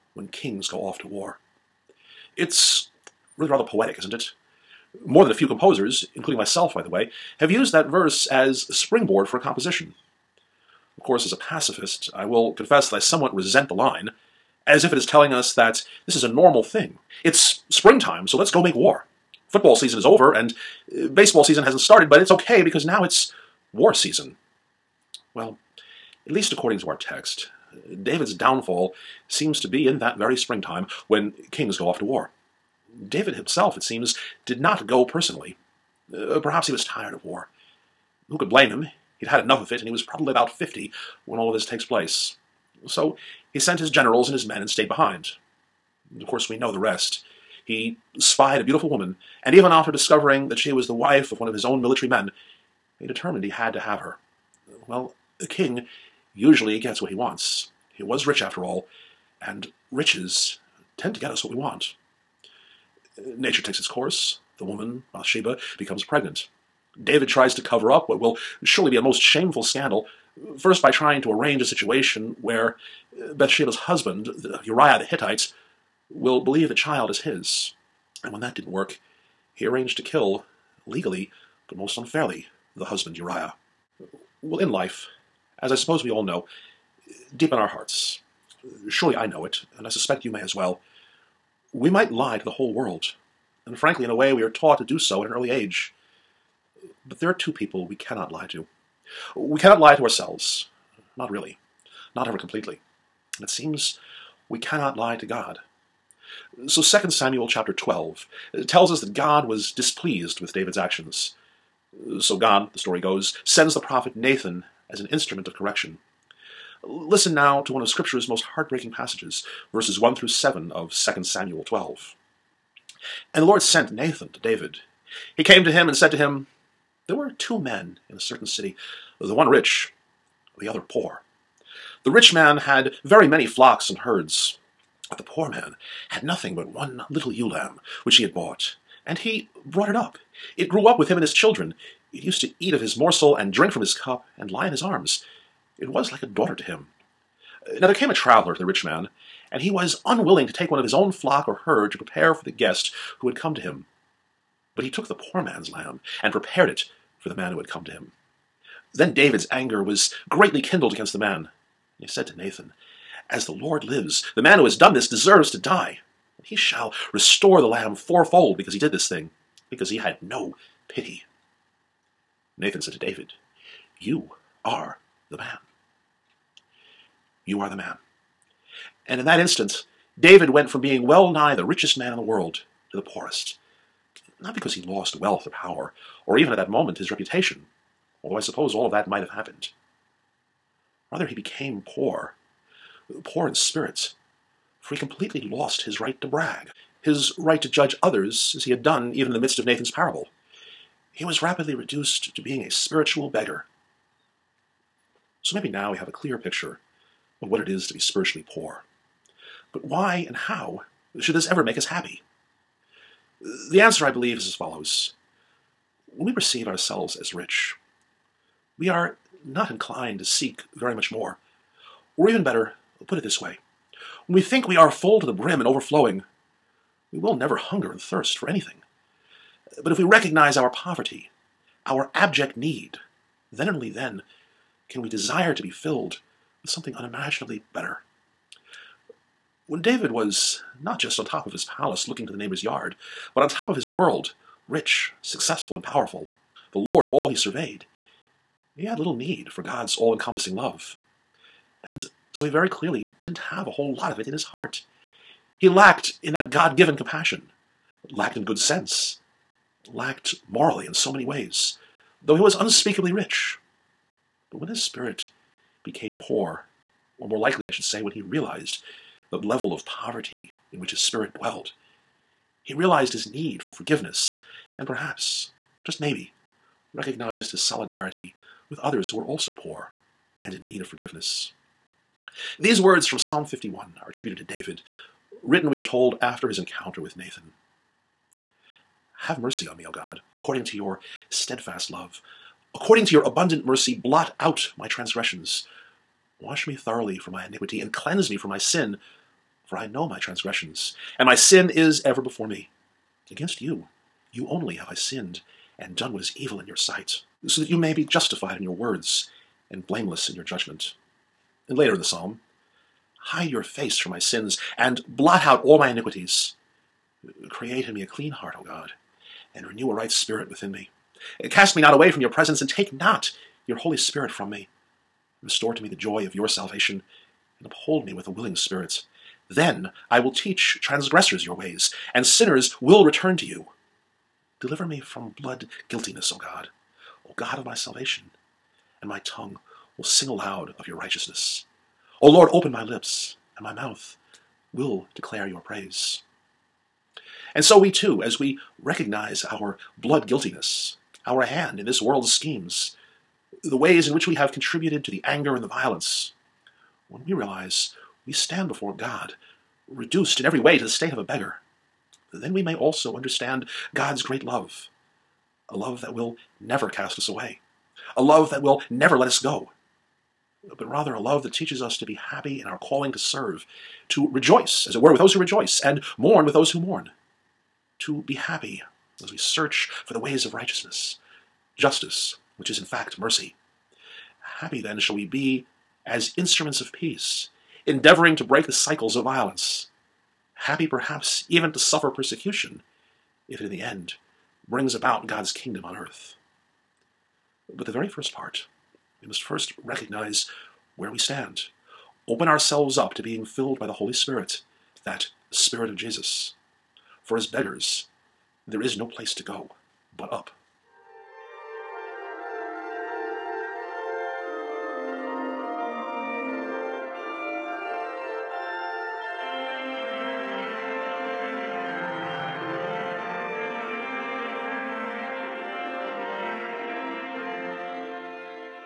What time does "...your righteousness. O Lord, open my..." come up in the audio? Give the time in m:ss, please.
5:40.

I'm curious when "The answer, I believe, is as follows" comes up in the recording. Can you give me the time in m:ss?
3:33.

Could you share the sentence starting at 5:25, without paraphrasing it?
Restore to me the joy of your salvation, and uphold me with a willing spirit.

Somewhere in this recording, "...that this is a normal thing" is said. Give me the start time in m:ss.
0:15.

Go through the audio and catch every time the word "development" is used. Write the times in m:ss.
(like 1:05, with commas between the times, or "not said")
not said.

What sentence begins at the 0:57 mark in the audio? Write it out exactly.
He was rich after all, and riches tend to get us what we want.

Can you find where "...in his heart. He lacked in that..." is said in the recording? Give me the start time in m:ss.
4:14.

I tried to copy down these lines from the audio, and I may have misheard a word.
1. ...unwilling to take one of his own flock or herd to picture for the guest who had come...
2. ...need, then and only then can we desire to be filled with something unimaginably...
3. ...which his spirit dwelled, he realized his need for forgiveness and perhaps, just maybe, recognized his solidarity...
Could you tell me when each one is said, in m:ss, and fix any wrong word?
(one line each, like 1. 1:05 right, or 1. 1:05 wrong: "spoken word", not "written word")
1. 2:30 wrong: "prepare", not "picture"
2. 3:52 right
3. 4:30 right.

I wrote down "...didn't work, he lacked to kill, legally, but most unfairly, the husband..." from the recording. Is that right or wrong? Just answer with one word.
wrong.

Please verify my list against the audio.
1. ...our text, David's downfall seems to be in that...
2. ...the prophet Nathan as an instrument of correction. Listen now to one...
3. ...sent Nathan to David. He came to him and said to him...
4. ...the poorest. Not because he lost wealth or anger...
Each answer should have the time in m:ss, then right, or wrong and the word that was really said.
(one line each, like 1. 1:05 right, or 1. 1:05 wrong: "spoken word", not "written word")
1. 0:26 right
2. 1:53 right
3. 2:03 right
4. 3:02 wrong: "power", not "anger".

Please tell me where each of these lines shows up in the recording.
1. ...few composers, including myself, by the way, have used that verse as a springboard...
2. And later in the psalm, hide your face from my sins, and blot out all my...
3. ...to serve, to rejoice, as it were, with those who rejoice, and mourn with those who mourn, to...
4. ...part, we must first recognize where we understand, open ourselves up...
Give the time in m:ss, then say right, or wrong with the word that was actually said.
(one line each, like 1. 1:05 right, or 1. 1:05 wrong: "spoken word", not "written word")
1. 0:05 right
2. 5:11 right
3. 6:13 right
4. 6:38 wrong: "stand", not "understand".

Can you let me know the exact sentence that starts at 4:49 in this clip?
Have mercy on me, O God, according to your steadfast love.